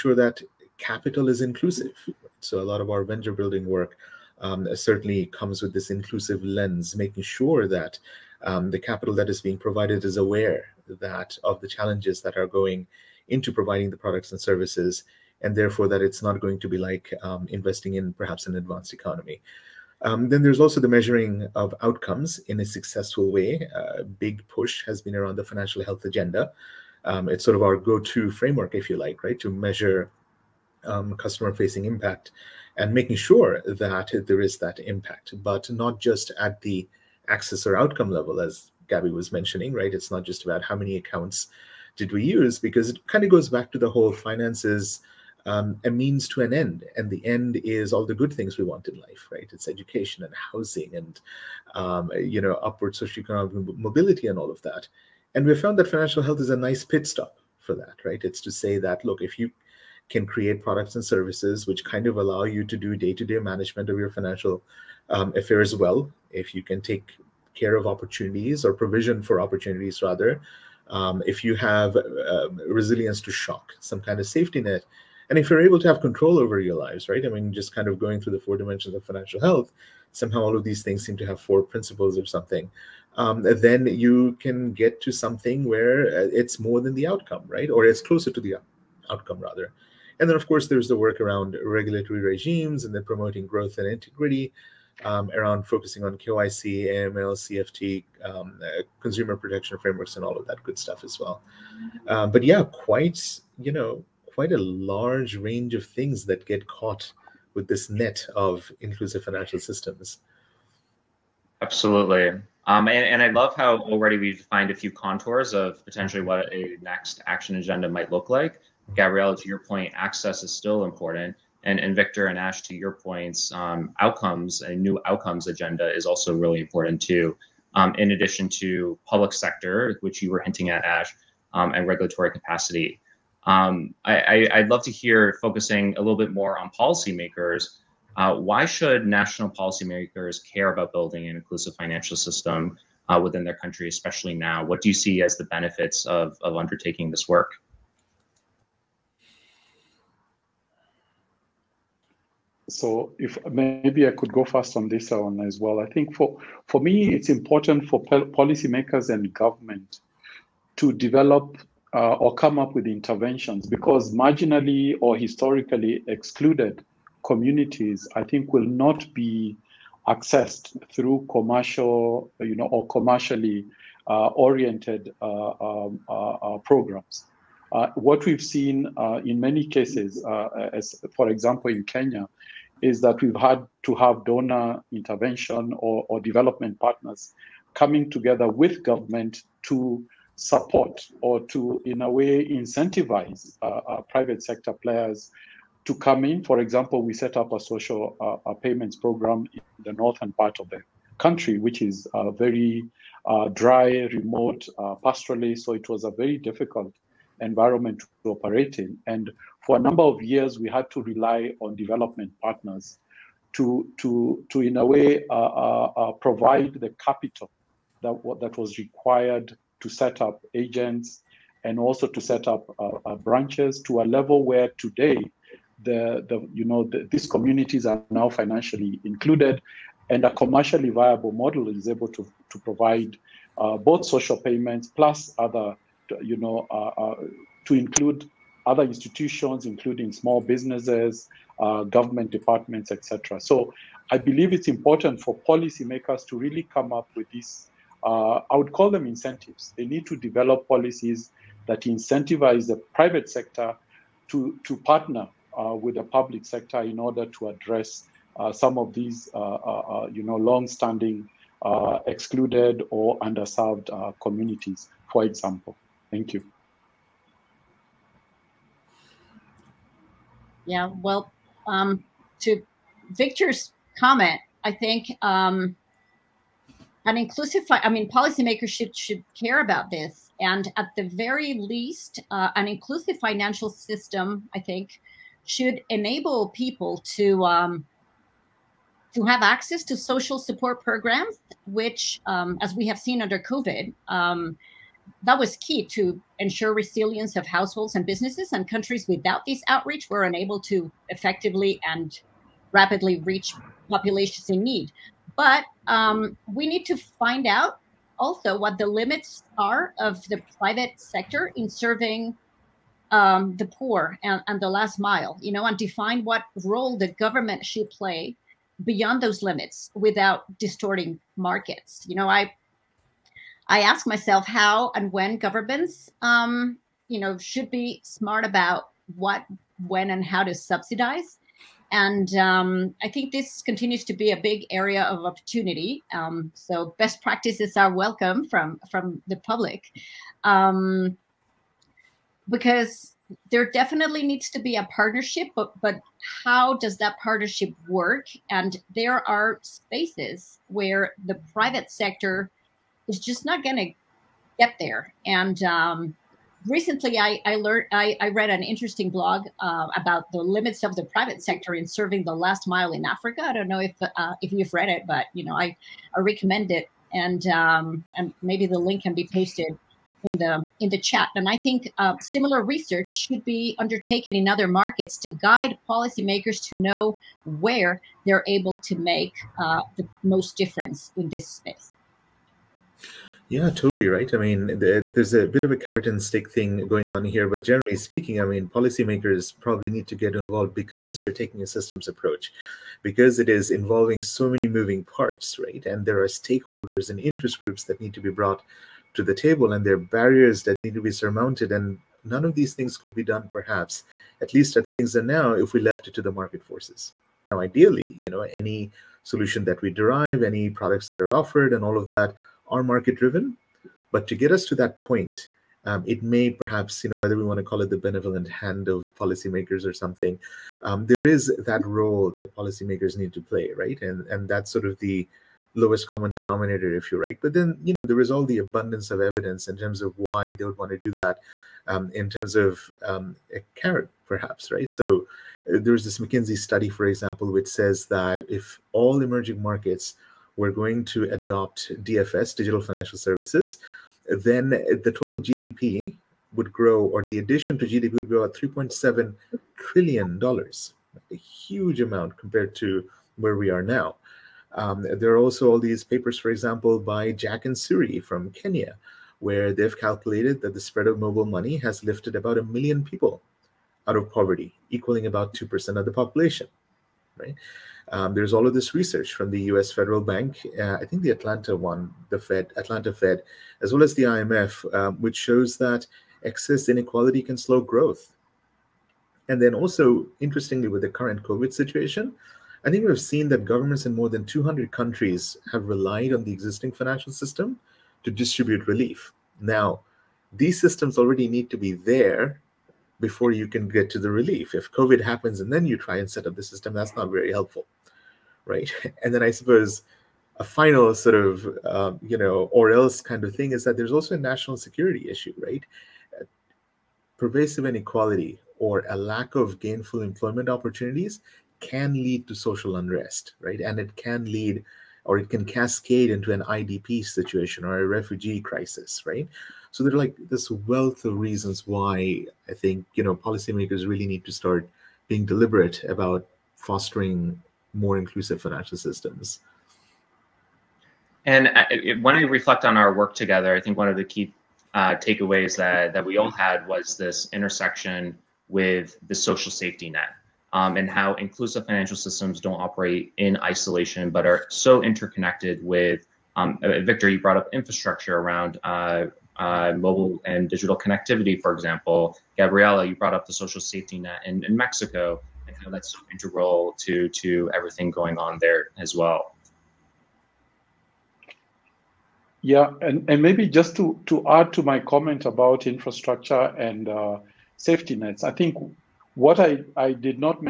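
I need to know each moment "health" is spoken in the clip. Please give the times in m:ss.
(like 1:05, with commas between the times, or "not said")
0:25, 0:56, 1:19.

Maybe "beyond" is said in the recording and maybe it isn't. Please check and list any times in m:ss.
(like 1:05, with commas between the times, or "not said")
5:18.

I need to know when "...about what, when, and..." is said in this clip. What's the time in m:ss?
5:28.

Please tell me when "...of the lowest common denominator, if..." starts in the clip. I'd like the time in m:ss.
7:04.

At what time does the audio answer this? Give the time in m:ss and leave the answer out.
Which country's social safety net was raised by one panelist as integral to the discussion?
9:14.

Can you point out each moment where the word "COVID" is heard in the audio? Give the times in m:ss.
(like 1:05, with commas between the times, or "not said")
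4:53, 8:01, 8:14.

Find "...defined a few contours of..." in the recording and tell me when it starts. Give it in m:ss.
1:54.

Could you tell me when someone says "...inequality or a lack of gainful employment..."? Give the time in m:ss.
8:27.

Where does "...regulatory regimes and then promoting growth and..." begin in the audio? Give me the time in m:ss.
1:31.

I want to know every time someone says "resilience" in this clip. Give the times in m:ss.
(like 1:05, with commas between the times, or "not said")
1:12, 4:56.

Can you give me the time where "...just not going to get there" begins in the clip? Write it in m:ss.
5:53.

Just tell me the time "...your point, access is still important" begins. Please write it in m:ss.
1:59.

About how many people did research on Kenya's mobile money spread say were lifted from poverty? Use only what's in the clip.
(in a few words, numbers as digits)
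a million.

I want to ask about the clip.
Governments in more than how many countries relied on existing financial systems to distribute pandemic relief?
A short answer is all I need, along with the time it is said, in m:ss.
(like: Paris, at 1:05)
200, at 8:04.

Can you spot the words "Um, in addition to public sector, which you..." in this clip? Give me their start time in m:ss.
2:07.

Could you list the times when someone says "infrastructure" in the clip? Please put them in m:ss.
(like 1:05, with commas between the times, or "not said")
9:07, 9:25.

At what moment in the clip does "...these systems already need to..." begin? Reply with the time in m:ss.
8:10.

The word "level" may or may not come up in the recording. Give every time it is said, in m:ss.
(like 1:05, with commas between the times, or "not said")
0:38, 3:44.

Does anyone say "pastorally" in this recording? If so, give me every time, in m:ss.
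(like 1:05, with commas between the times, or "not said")
3:25.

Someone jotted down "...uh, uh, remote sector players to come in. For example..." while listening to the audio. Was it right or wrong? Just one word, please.
wrong.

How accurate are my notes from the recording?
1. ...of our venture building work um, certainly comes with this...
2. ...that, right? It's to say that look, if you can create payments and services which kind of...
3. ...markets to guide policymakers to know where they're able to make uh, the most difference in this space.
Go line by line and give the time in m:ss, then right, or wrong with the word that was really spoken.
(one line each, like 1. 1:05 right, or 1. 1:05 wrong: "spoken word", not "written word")
1. 0:02 right
2. 0:57 wrong: "products", not "payments"
3. 6:14 right.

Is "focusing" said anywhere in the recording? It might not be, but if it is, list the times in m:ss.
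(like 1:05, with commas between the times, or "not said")
1:35, 2:15.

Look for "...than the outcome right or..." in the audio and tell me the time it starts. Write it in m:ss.
1:26.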